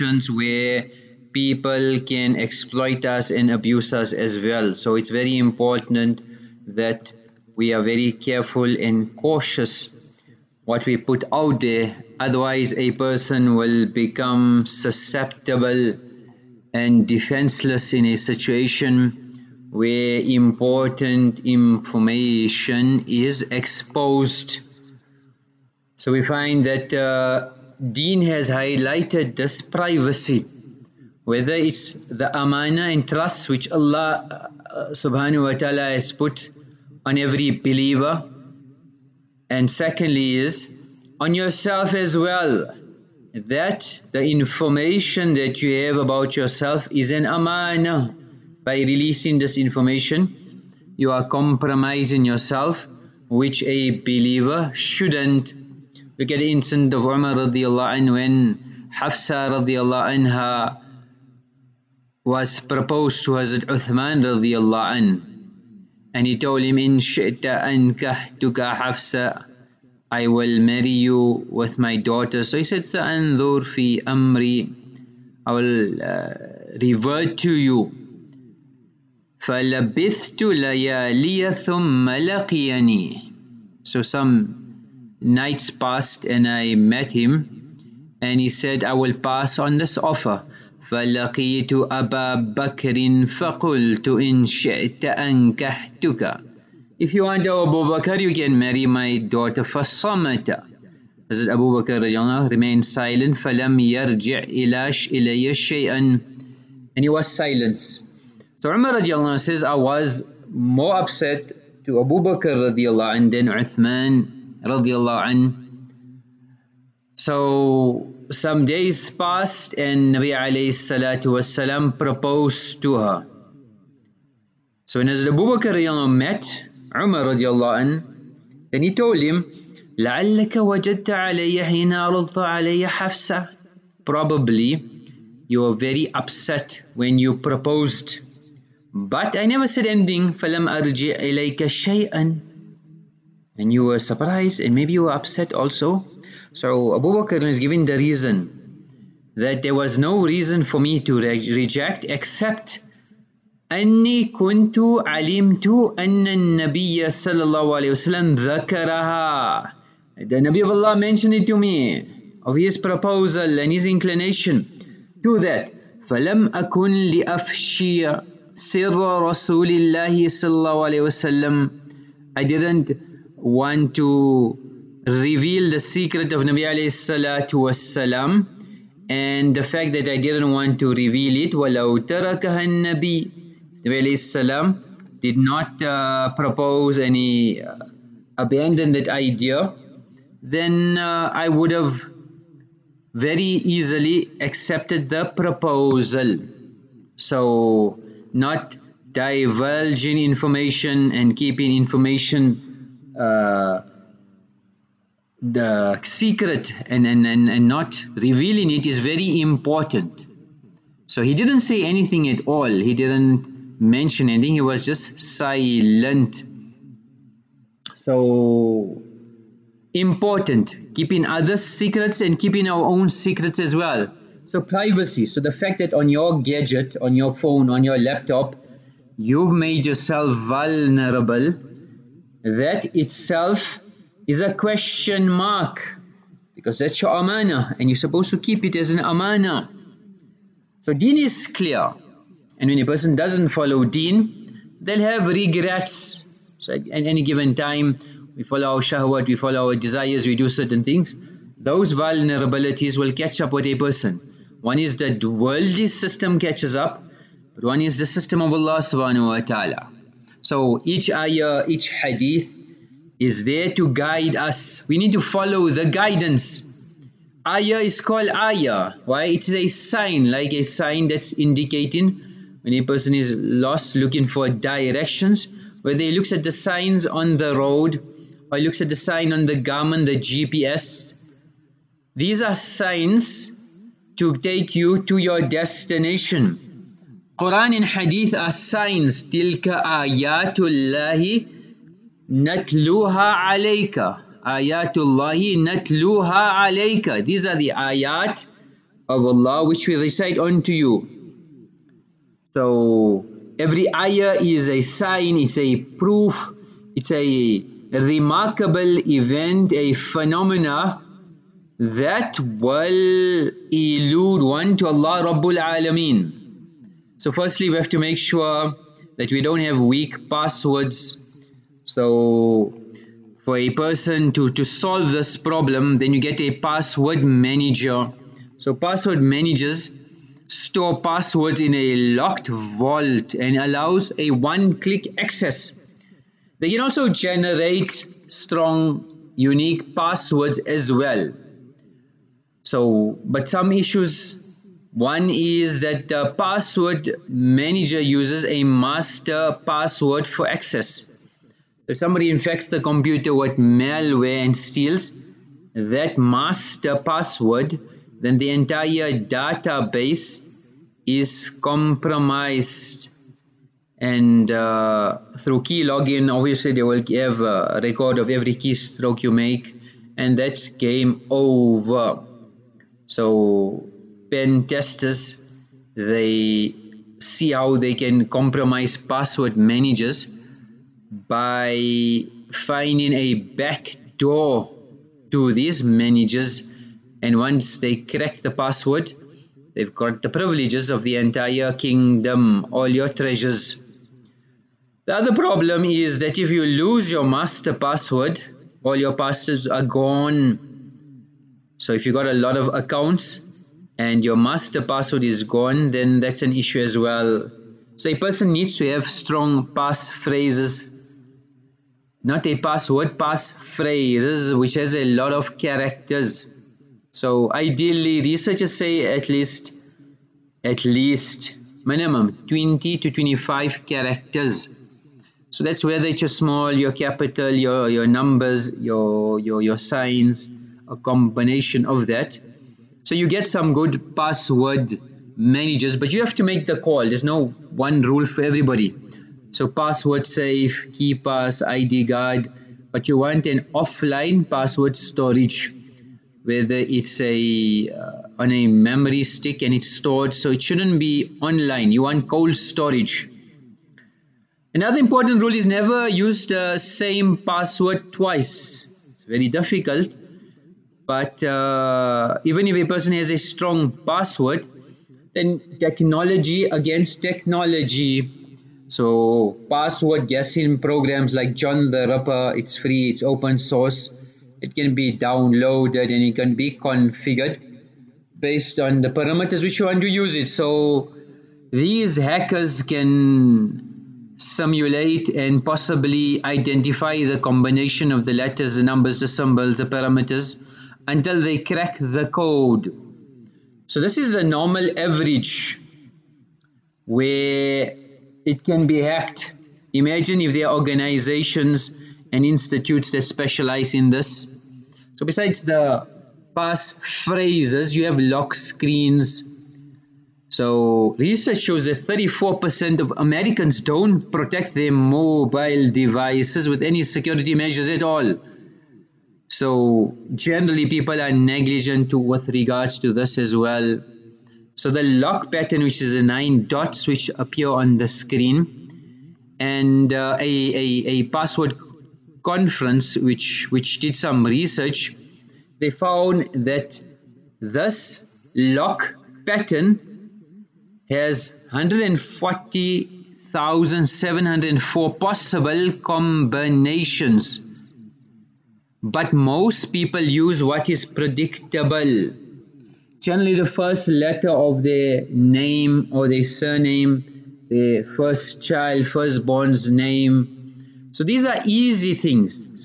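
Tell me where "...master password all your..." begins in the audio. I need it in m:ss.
6:37.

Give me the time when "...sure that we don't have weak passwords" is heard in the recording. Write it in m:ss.
5:18.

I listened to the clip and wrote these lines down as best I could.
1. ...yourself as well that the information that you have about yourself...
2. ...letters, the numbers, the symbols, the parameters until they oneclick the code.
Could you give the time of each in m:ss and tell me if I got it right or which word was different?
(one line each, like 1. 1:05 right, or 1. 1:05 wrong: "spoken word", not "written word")
1. 0:41 right
2. 8:08 wrong: "crack", not "oneclick".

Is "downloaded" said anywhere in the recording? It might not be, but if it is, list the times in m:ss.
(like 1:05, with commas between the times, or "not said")
7:55.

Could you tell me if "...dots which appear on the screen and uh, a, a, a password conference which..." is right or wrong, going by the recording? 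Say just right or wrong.
right.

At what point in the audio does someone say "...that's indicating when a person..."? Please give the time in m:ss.
4:31.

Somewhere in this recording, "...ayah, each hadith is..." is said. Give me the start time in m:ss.
4:21.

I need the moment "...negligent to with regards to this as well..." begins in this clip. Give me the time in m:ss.
8:41.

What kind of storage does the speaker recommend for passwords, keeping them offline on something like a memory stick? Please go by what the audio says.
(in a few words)
Cold storage.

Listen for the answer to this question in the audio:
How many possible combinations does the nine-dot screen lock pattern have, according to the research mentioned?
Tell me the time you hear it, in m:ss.
9:01.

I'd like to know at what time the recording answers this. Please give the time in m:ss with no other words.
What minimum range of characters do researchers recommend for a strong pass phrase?
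7:02.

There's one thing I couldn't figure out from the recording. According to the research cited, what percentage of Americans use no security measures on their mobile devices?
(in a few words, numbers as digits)
34%.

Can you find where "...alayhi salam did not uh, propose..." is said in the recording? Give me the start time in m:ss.
3:04.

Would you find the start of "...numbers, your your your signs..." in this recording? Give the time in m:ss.
7:08.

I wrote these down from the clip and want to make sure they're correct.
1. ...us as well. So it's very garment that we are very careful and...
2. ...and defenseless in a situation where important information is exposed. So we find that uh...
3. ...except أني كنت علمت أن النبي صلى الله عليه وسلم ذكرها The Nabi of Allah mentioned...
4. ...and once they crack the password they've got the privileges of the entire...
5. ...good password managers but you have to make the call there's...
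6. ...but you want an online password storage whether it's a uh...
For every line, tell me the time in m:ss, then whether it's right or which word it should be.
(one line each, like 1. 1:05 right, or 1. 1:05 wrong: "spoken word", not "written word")
1. 0:03 wrong: "important", not "garment"
2. 0:16 right
3. 2:32 right
4. 6:27 right
5. 7:13 right
6. 7:22 wrong: "offline", not "online".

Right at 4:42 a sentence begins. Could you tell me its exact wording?
These are signs to take you to your destination.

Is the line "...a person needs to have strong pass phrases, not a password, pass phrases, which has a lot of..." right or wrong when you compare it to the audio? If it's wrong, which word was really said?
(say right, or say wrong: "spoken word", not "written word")
right.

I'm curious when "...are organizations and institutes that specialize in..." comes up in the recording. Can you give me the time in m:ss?
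8:20.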